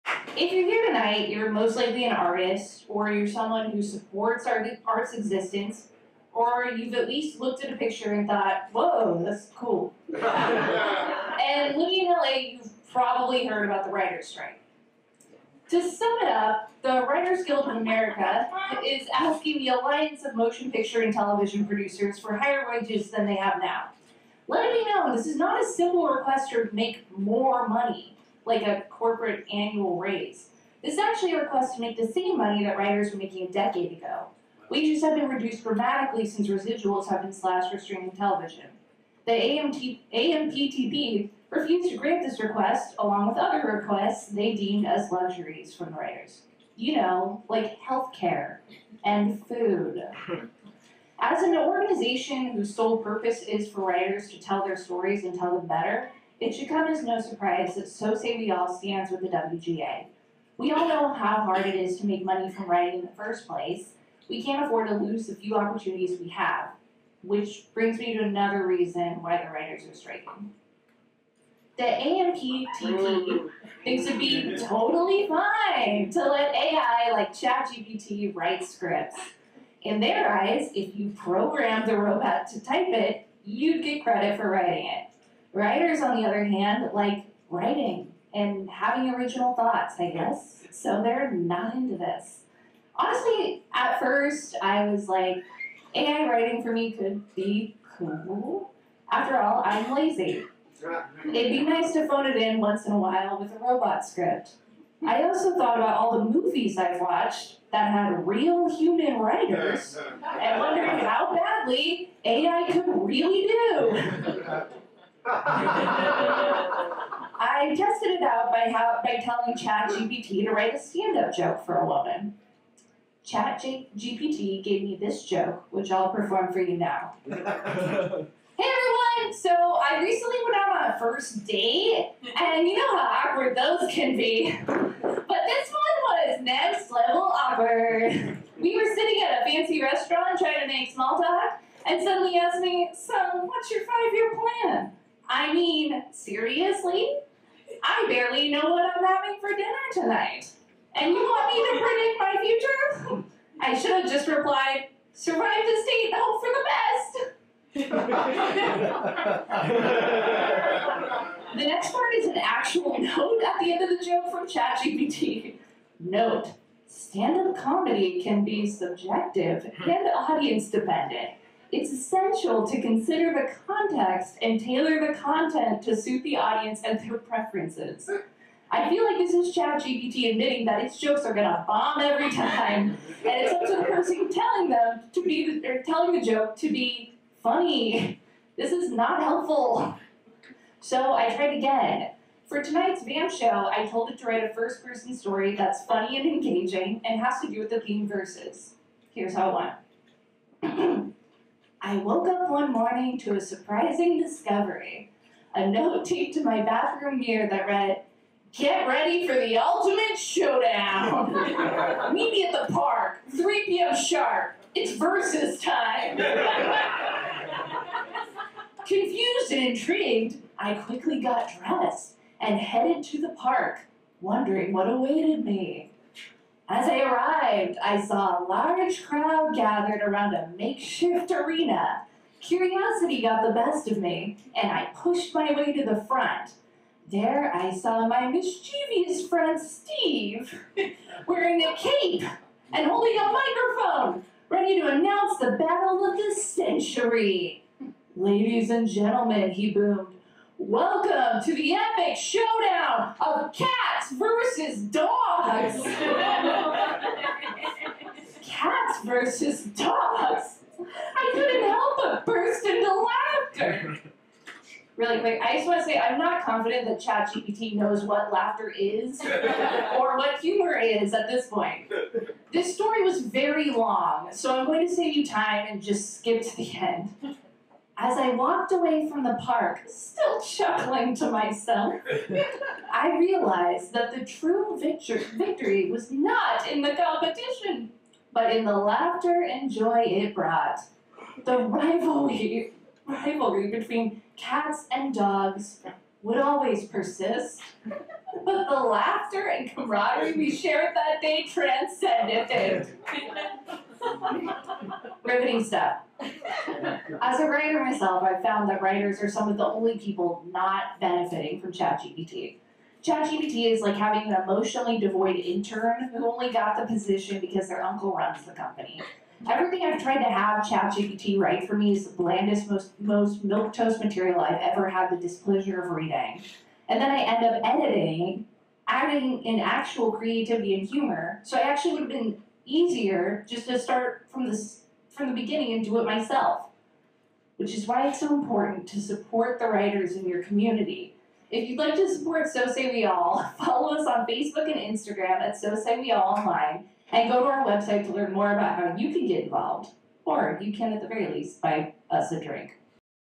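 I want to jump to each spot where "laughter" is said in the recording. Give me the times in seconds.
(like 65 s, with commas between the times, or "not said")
262 s, 268 s, 288 s, 298 s.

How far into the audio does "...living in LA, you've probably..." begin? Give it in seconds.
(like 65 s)
11 s.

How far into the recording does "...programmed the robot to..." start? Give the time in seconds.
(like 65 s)
81 s.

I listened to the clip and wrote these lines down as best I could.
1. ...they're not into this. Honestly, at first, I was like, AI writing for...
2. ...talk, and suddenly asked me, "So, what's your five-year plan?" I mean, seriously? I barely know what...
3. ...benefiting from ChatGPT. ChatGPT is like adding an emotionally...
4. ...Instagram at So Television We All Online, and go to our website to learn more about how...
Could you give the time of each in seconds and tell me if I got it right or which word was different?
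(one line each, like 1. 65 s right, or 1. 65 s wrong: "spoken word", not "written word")
1. 91 s right
2. 141 s right
3. 310 s wrong: "having", not "adding"
4. 344 s wrong: "Say", not "Television".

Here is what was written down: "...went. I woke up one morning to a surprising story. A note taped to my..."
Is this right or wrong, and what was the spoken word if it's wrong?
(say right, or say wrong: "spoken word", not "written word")
wrong: "discovery", not "story".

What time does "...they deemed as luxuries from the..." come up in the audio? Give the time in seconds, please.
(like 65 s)
44 s.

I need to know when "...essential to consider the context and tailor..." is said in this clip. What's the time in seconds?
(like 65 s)
171 s.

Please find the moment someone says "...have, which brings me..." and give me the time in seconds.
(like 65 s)
66 s.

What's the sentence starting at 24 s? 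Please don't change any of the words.
Let me know, this is not a simple request to make more money like a corporate annual raise.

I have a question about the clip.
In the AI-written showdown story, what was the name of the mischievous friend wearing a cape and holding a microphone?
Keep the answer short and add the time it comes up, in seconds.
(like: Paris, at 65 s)
Steve, at 239 s.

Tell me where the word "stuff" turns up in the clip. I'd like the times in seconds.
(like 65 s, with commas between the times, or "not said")
305 s.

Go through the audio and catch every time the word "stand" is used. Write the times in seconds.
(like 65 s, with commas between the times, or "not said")
58 s, 120 s, 166 s.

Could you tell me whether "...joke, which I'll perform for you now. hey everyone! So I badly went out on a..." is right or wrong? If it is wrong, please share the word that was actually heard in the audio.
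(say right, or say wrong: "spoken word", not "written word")
wrong: "recently", not "badly".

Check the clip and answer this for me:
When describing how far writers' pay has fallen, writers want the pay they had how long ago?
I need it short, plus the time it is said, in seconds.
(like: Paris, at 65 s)
a decade ago, at 33 s.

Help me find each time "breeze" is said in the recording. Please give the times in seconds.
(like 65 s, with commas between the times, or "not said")
not said.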